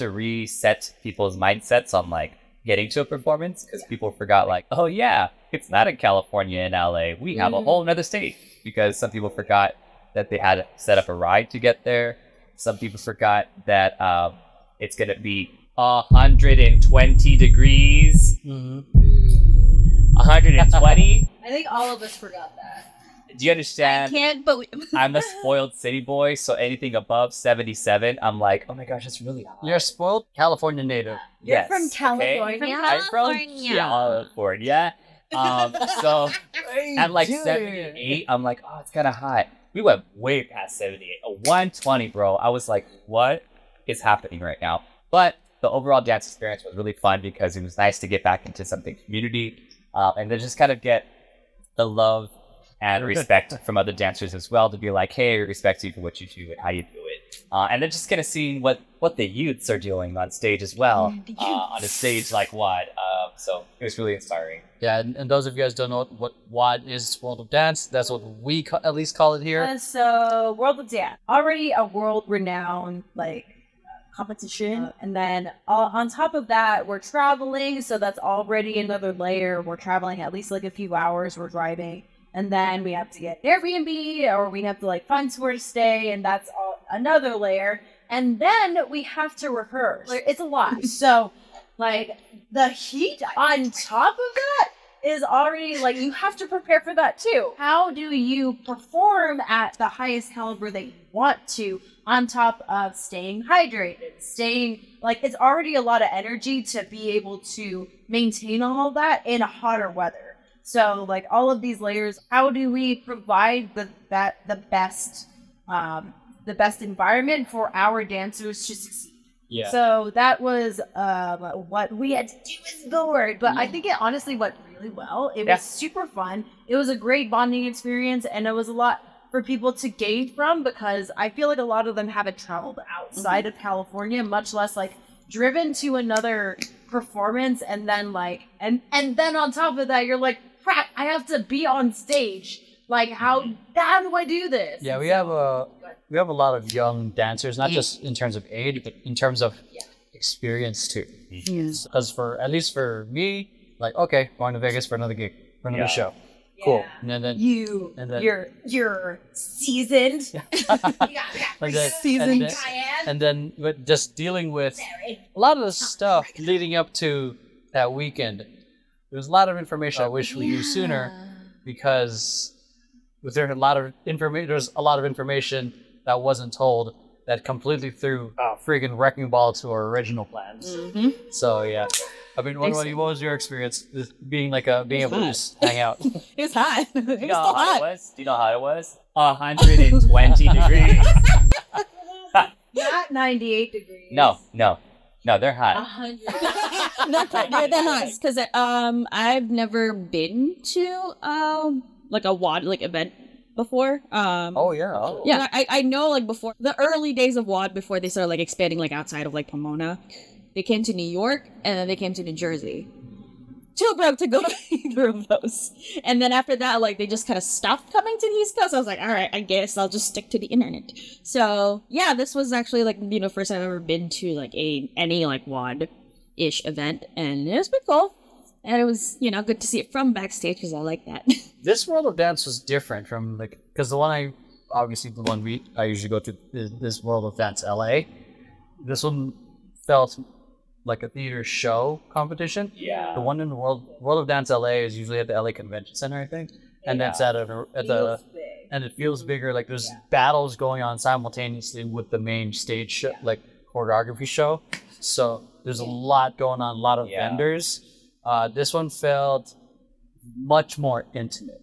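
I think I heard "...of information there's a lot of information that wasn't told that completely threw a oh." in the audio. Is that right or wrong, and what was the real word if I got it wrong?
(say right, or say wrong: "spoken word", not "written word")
right.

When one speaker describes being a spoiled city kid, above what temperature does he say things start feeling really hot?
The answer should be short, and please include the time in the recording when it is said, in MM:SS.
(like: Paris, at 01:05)
77, at 00:27.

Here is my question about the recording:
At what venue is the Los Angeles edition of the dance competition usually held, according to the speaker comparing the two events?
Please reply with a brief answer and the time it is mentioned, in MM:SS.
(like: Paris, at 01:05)
LA Convention Center, at 04:05.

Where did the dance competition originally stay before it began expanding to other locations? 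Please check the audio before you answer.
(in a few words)
Pomona.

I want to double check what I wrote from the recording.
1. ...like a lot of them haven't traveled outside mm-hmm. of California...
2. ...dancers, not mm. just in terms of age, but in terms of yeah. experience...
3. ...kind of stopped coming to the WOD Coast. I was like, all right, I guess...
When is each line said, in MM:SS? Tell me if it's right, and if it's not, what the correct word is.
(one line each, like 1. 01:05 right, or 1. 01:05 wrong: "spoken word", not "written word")
1. 02:11 right
2. 02:27 right
3. 03:37 wrong: "East", not "WOD".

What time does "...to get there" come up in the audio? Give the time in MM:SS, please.
00:11.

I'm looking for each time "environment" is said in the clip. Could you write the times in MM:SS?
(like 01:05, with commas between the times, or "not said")
01:56.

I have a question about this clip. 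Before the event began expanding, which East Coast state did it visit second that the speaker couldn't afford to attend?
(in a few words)
New Jersey.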